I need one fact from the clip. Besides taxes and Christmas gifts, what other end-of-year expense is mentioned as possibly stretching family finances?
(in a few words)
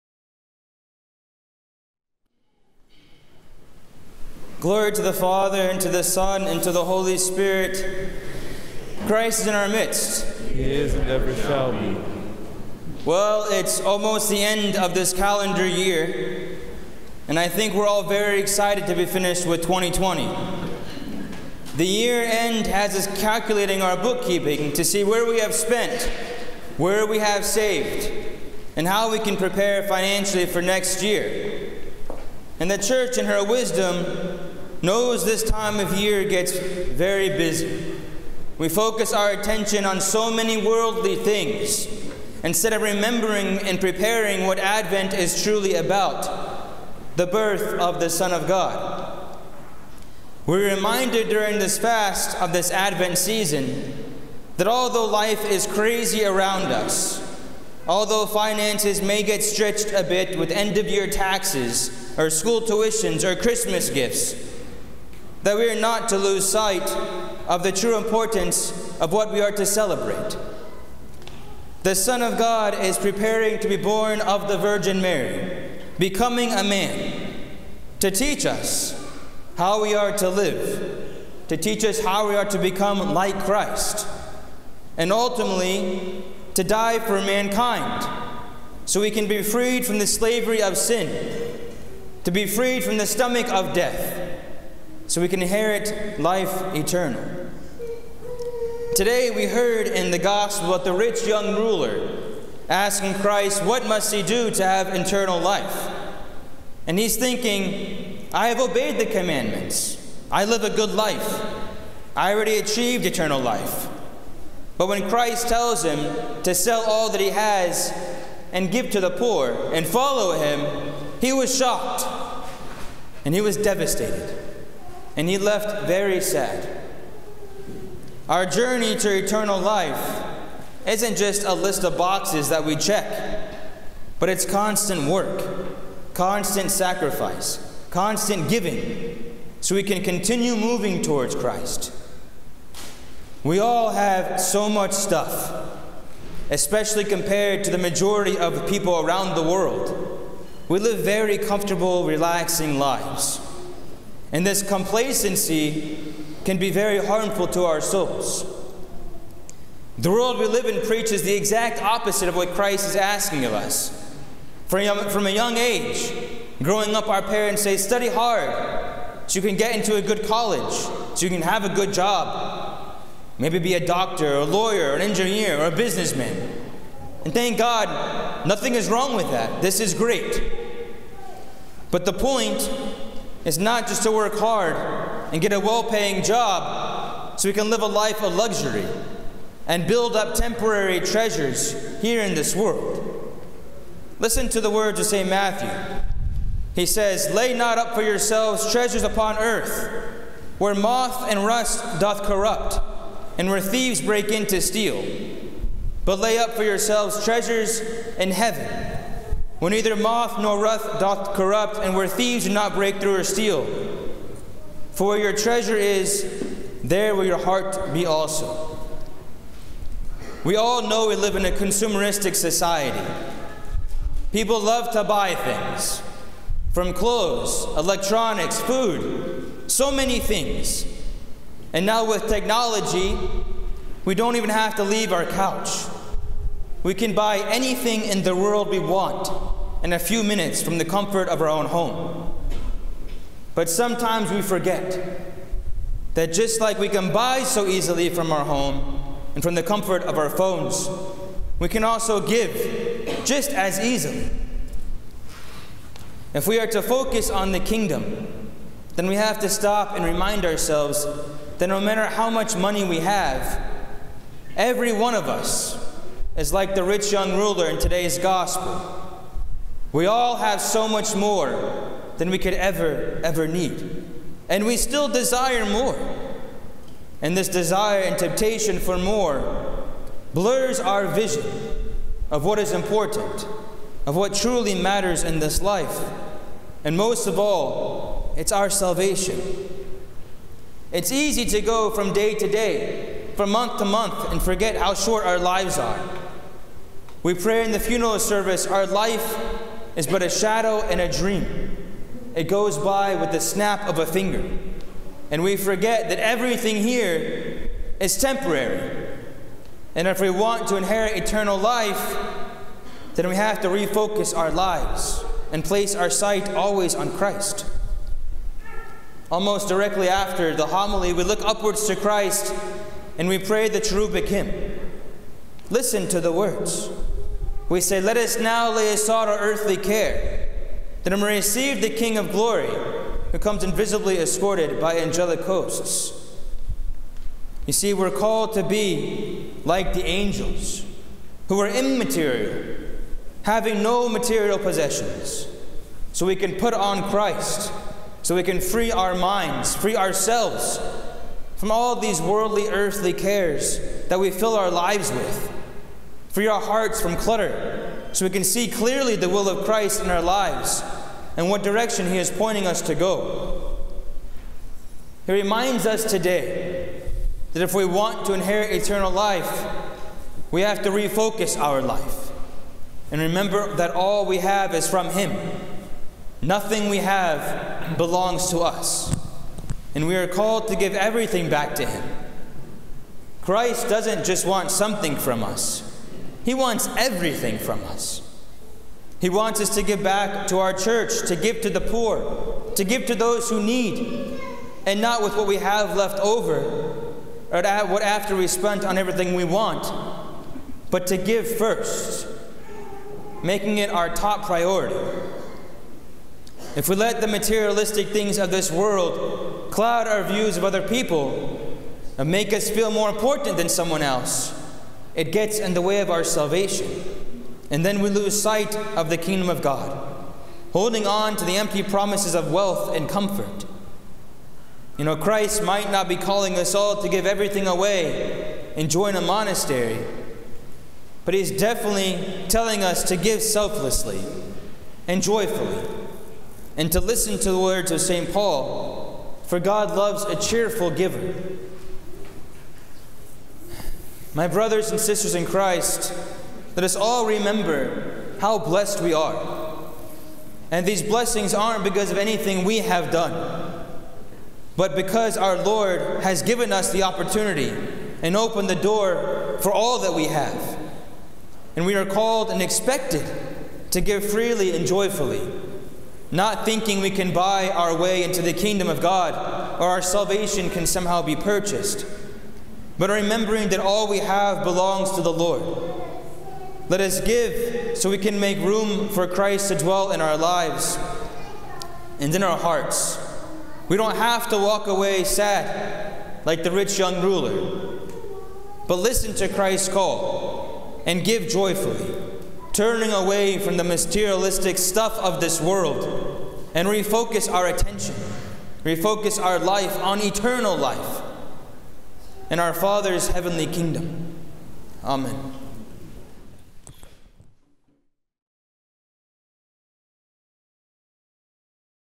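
school tuitions.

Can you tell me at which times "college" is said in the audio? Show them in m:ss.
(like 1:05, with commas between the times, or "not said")
2:50.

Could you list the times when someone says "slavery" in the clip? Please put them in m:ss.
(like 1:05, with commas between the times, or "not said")
1:30.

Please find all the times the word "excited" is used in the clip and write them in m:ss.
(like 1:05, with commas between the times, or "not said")
0:18.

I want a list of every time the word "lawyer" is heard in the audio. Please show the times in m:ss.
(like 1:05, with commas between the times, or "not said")
2:54.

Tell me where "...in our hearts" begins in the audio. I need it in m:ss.
8:02.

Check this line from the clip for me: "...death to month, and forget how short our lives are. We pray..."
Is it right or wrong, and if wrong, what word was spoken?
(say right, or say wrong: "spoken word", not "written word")
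wrong: "month", not "death".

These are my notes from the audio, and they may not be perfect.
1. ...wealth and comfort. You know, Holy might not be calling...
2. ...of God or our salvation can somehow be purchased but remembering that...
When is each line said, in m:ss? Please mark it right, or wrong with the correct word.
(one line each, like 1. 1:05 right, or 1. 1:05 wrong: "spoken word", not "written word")
1. 7:02 wrong: "Christ", not "Holy"
2. 7:48 right.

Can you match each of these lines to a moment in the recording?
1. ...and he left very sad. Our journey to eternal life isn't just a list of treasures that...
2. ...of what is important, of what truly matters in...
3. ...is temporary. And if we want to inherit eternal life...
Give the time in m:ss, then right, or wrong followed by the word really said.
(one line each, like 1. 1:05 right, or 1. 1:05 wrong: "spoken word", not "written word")
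1. 2:05 wrong: "boxes", not "treasures"
2. 4:42 right
3. 5:07 right.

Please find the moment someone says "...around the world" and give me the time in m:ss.
2:29.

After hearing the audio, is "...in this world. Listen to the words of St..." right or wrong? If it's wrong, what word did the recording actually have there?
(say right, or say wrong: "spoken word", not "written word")
right.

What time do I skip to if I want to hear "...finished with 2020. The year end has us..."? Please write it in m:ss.
0:19.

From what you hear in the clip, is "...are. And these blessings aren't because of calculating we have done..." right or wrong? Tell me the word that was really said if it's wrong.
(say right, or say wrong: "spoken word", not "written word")
wrong: "anything", not "calculating".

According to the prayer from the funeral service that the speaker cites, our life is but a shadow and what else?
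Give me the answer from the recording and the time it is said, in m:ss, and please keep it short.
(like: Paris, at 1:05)
a dream, at 5:01.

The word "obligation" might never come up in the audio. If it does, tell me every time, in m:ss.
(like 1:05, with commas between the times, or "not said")
not said.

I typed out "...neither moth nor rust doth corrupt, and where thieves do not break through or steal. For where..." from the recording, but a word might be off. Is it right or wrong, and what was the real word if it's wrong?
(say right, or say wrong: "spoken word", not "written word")
right.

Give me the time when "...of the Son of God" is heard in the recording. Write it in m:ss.
0:47.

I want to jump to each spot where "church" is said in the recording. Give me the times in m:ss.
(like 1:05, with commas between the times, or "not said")
0:32, 6:30.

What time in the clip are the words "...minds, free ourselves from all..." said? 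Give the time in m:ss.
5:49.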